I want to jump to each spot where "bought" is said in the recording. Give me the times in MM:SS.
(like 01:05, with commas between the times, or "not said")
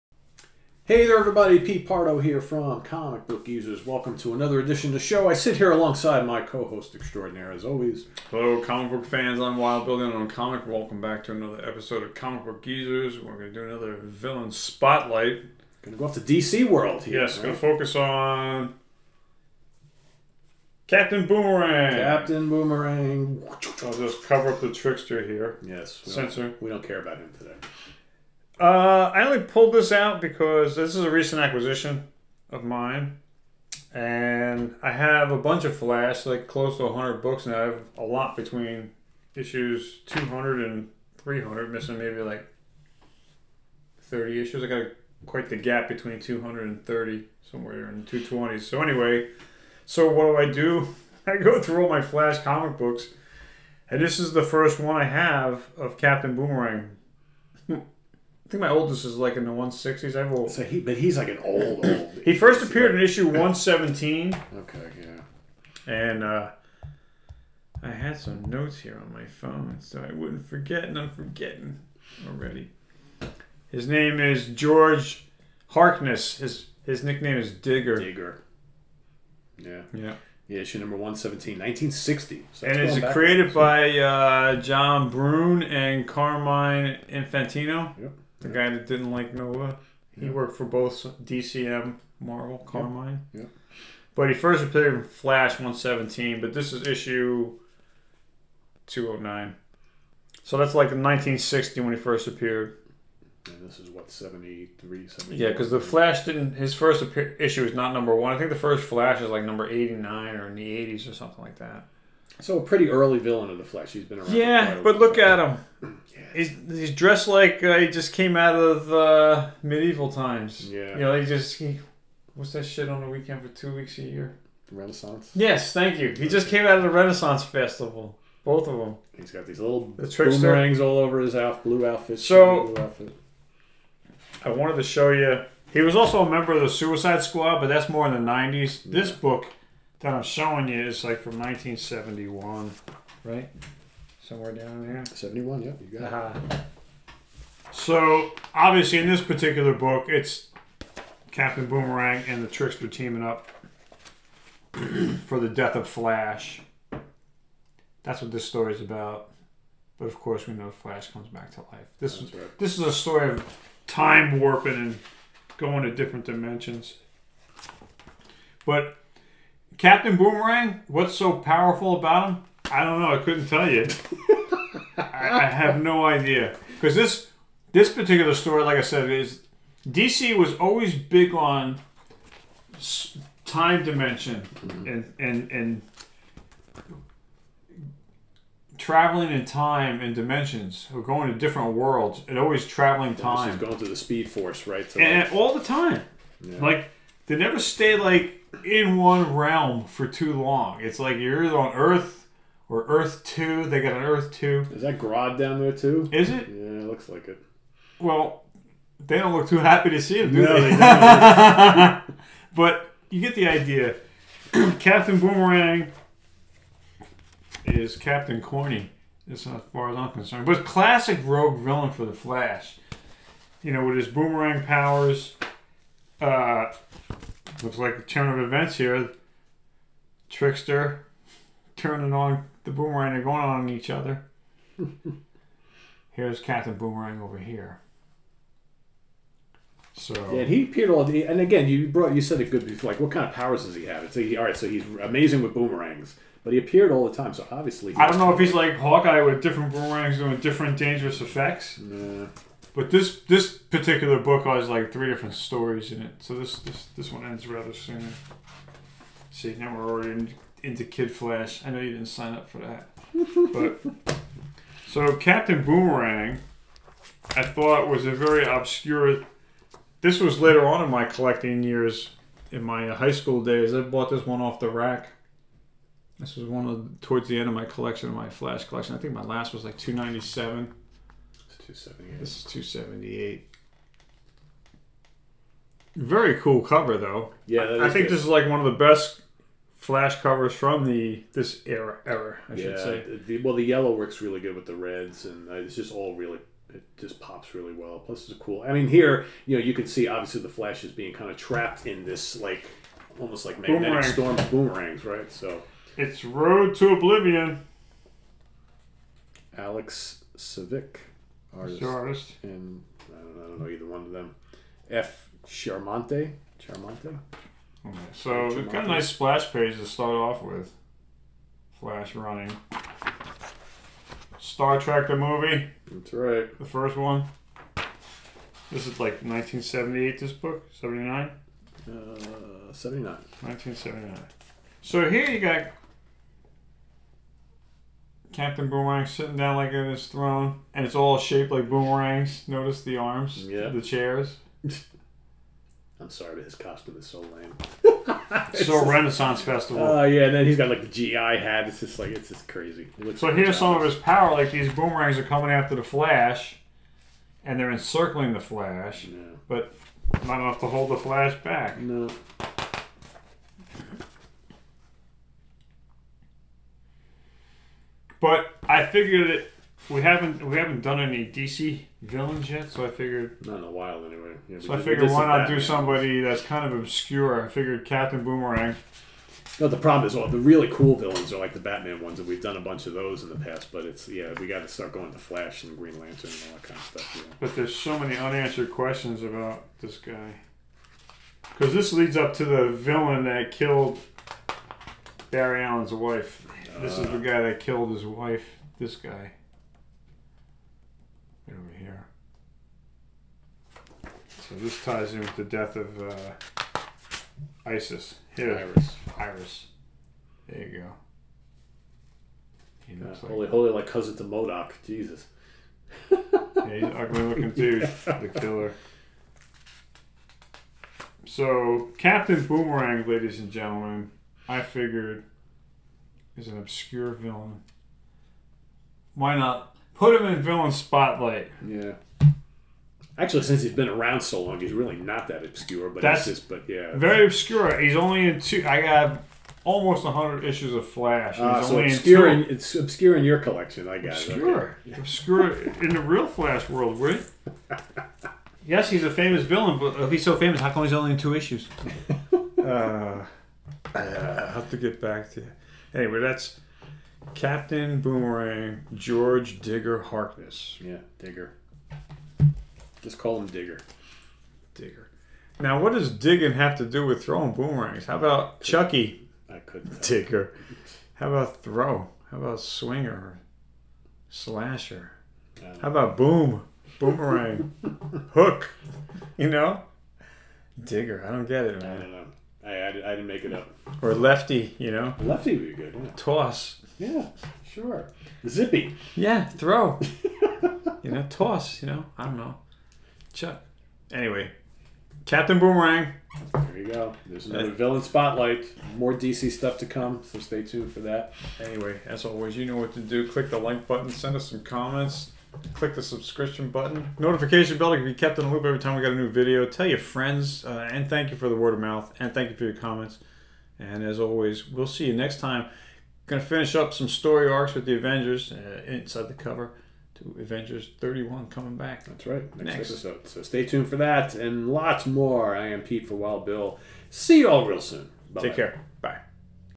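04:33.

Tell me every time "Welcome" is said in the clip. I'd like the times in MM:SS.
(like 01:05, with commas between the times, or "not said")
00:03, 00:10.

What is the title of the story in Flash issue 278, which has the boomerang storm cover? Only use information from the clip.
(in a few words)
Road to Oblivion.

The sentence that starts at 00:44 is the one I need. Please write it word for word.
I got a, quite the gap between 200 and 30, somewhere in the 220s.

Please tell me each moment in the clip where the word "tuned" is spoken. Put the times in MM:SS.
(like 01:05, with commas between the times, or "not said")
08:20, 08:43.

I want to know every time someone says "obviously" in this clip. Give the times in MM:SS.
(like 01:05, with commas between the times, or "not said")
02:28, 04:07, 05:00.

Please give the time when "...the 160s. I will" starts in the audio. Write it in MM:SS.
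00:59.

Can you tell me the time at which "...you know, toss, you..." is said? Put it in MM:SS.
08:11.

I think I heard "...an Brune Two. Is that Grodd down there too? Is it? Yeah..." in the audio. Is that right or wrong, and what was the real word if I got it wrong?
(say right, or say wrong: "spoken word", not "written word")
wrong: "Earth", not "Brune".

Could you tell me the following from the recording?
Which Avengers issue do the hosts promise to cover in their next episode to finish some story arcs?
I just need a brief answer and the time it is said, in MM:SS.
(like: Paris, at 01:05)
31, at 08:40.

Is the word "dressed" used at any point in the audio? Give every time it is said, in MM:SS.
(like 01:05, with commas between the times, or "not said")
01:56.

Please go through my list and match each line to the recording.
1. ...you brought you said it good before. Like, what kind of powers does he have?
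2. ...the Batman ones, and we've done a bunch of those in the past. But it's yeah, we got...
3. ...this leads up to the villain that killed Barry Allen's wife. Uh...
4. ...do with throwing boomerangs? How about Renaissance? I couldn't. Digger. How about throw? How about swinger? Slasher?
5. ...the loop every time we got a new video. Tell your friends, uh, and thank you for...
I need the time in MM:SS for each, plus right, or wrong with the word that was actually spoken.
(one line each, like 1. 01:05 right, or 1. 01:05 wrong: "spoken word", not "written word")
1. 04:01 right
2. 06:21 right
3. 06:31 right
4. 07:46 wrong: "Chucky", not "Renaissance"
5. 08:28 right.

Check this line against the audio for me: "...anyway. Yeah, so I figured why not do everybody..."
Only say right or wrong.
wrong.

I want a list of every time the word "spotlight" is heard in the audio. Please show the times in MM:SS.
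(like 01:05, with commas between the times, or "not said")
00:14, 07:10, 08:18.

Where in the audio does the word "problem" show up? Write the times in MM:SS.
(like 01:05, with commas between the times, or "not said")
06:19.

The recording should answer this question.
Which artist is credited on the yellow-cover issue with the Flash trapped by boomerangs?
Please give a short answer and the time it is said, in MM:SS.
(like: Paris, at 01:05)
Alex Saviuk, at 05:09.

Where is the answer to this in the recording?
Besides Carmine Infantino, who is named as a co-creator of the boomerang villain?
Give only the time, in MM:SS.
01:24.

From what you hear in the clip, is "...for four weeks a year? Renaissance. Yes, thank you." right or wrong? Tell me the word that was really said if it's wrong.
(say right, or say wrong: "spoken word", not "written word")
wrong: "two", not "four".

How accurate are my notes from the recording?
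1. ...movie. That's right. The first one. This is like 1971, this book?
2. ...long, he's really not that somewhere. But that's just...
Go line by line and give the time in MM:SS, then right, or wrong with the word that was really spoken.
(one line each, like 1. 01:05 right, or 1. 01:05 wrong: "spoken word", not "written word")
1. 05:25 wrong: "1978", not "1971"
2. 07:14 wrong: "obscure", not "somewhere".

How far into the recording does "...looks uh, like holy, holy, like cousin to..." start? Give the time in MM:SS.
06:53.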